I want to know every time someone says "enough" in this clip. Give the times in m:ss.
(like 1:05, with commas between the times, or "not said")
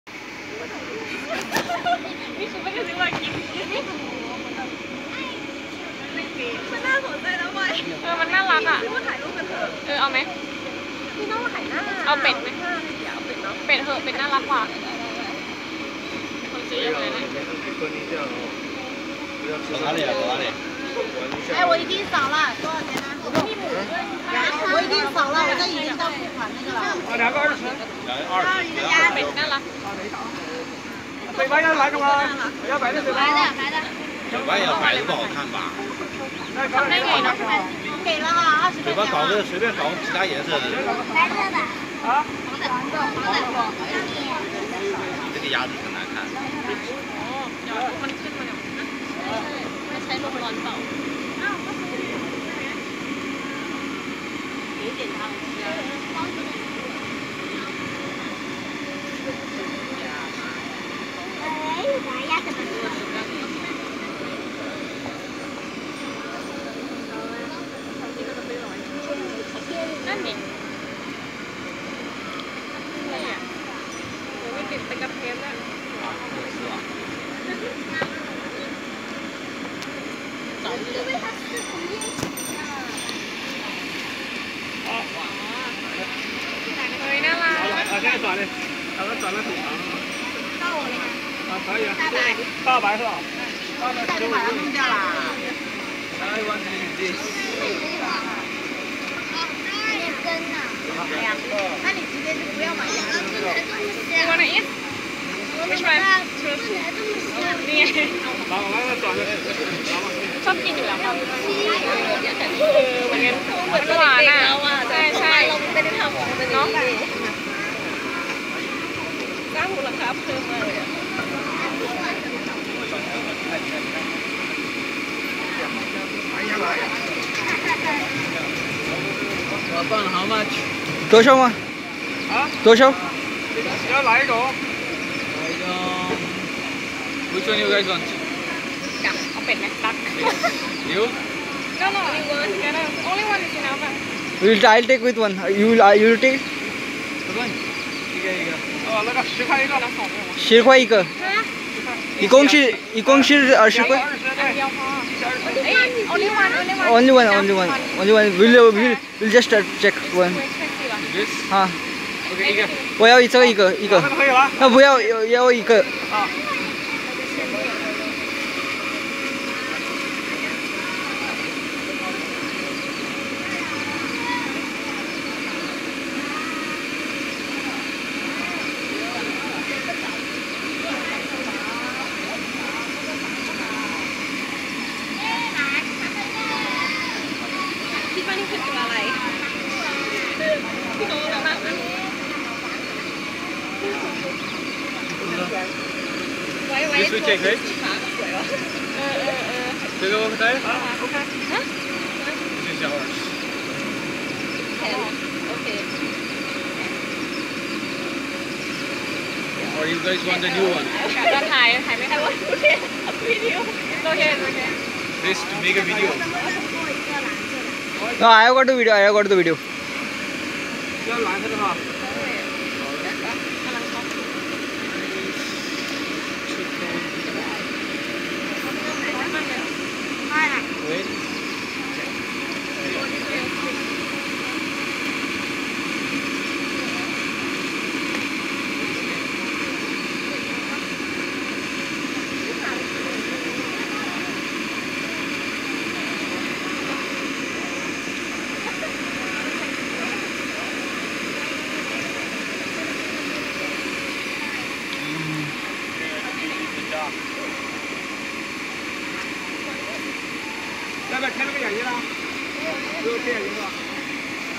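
2:23.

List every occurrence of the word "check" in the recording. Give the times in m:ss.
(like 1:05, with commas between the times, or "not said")
2:39.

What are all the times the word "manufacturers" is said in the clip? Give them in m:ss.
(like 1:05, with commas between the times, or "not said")
not said.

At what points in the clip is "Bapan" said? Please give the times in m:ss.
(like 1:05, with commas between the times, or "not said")
2:00.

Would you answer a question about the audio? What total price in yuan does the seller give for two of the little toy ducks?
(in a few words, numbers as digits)
20.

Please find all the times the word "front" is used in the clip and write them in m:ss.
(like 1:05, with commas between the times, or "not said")
not said.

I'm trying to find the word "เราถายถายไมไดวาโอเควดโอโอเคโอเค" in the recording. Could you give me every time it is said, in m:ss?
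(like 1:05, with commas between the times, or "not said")
3:31.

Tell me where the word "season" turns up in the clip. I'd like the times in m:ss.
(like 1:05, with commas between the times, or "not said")
not said.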